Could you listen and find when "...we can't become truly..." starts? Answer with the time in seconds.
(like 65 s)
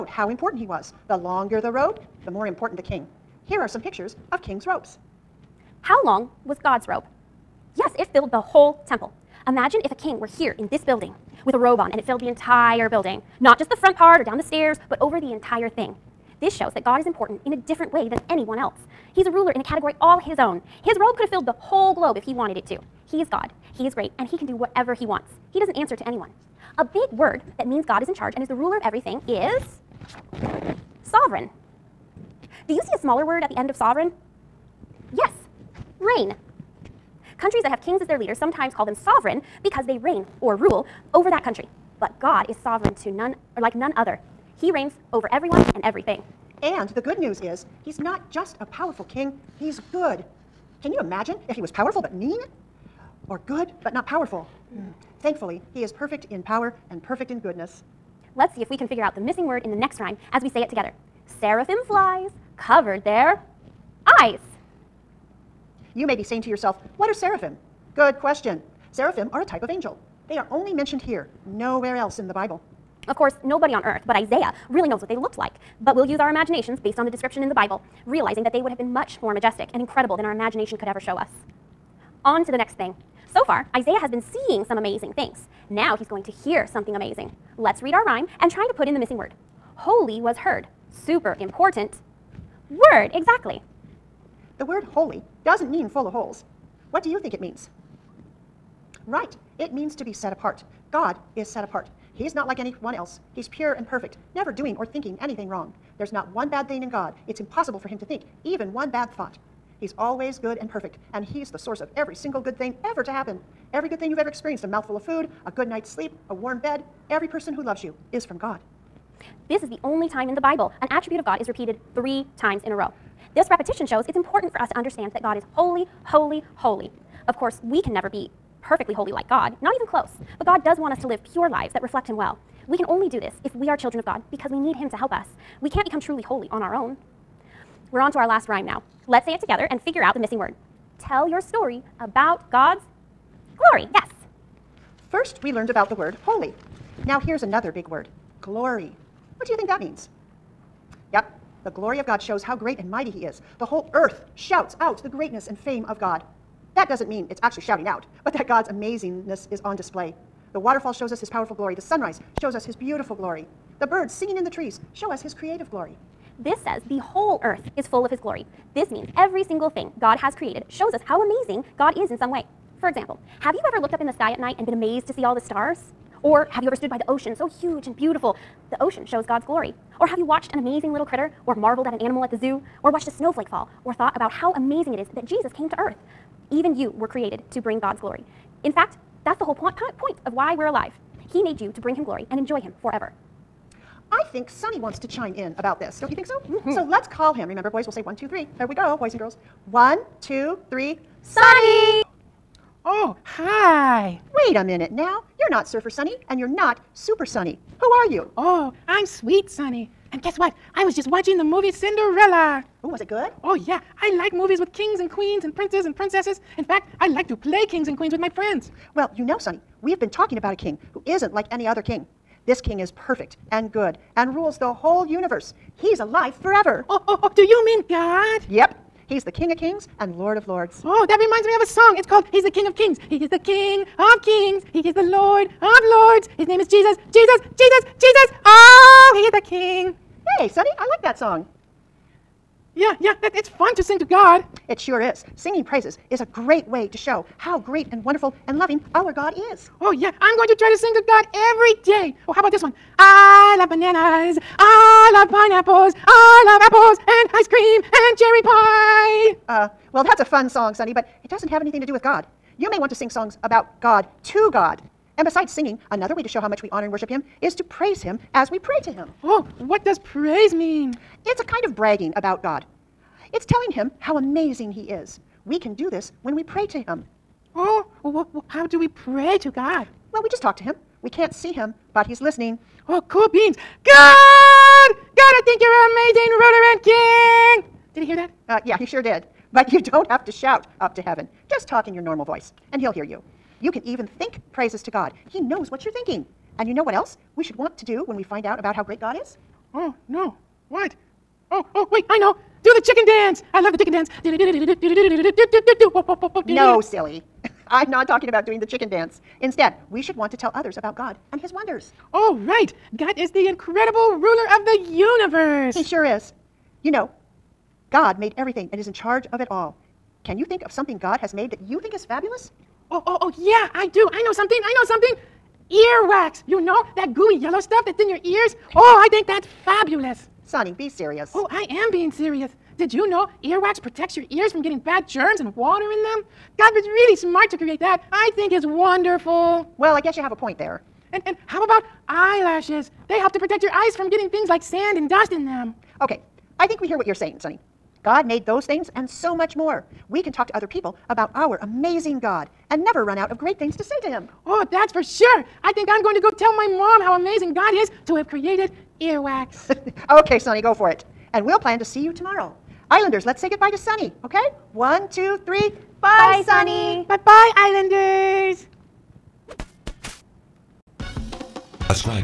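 135 s.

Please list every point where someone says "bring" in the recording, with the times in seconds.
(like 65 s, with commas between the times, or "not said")
187 s, 191 s.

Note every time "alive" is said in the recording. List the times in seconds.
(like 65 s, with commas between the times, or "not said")
190 s, 225 s.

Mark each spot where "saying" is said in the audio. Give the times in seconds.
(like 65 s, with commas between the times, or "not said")
66 s, 347 s.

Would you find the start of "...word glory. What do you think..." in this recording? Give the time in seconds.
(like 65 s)
147 s.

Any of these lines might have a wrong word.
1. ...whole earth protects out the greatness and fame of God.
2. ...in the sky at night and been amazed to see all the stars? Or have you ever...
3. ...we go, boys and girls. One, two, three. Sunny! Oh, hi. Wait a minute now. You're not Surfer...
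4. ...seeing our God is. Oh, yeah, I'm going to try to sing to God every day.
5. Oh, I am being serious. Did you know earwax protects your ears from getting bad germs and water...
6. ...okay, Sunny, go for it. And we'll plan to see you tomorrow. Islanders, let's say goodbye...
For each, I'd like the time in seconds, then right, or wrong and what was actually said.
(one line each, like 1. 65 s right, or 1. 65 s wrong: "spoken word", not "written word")
1. 153 s wrong: "shouts", not "protects"
2. 174 s right
3. 198 s right
4. 248 s wrong: "loving", not "seeing"
5. 331 s right
6. 360 s right.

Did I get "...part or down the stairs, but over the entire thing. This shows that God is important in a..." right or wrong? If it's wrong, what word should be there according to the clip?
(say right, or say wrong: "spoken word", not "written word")
right.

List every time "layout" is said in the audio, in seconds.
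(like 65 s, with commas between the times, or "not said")
not said.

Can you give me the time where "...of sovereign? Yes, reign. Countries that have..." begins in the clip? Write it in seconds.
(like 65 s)
33 s.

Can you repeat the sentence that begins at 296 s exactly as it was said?
And you know what else we should want to do when we find out about how great God is?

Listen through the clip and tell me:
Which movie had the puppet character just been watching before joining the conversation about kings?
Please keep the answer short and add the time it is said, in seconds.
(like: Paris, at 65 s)
Cinderella, at 211 s.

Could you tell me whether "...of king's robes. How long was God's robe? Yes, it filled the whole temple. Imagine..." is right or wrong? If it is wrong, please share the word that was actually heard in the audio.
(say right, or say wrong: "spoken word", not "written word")
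right.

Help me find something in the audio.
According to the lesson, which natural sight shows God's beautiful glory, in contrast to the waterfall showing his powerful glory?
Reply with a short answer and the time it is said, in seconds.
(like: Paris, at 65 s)
The sunrise, at 161 s.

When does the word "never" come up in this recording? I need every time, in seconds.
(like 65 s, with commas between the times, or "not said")
104 s, 127 s, 352 s.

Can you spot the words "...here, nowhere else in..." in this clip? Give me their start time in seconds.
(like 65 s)
71 s.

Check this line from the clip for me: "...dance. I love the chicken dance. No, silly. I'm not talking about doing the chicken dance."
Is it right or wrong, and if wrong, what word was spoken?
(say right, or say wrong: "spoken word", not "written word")
right.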